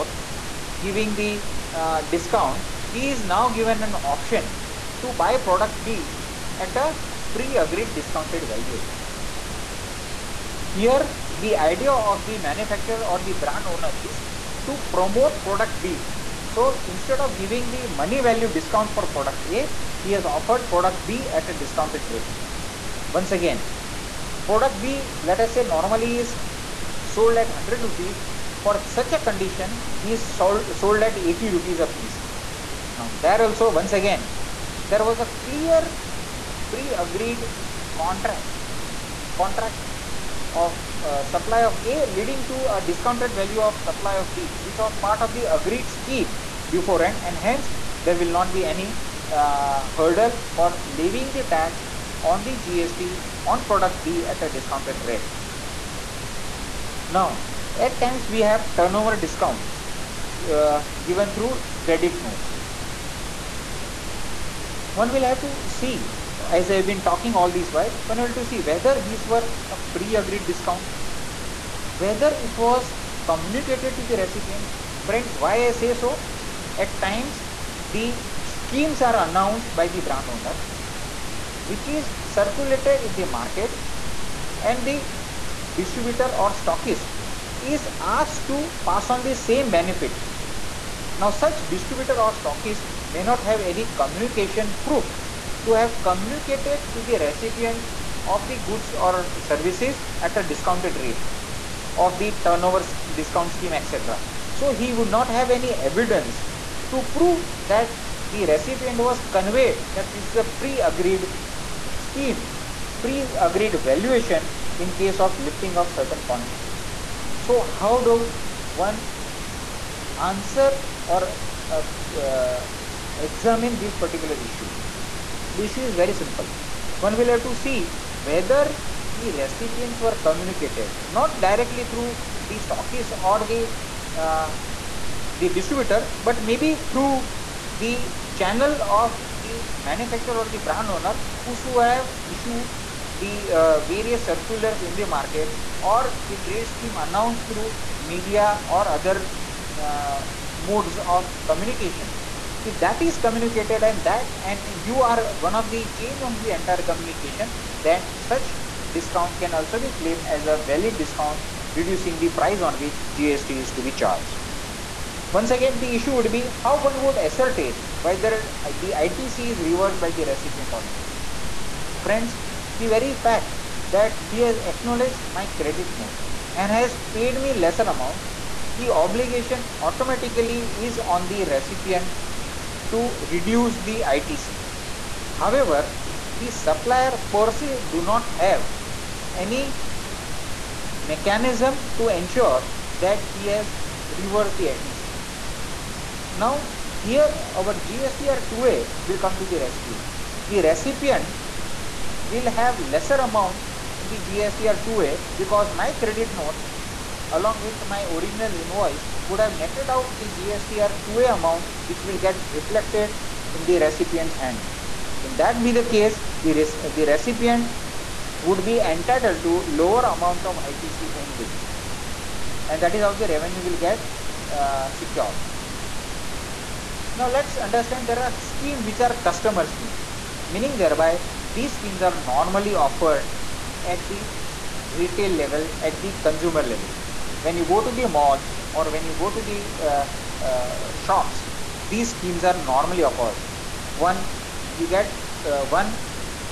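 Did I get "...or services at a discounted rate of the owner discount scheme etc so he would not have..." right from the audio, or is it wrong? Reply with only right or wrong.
wrong.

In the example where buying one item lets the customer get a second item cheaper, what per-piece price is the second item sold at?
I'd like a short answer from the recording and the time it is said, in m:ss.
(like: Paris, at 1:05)
80 rupees, at 0:31.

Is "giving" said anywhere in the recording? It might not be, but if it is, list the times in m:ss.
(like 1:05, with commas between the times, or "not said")
0:00, 0:17.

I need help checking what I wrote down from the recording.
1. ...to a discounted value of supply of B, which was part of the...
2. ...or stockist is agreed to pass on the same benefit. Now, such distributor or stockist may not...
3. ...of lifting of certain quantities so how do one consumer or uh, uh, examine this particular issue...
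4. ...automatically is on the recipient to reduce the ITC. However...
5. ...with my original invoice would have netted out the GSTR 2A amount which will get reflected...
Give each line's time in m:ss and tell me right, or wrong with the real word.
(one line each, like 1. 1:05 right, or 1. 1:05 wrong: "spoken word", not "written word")
1. 0:42 right
2. 1:26 wrong: "asked", not "agreed"
3. 1:55 wrong: "answer", not "consumer"
4. 2:59 right
5. 3:27 right.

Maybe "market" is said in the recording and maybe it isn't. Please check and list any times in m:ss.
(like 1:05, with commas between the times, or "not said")
1:23, 2:25.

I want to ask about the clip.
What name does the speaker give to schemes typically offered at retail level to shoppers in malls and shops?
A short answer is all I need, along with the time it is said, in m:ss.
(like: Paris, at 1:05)
customer schemes, at 3:49.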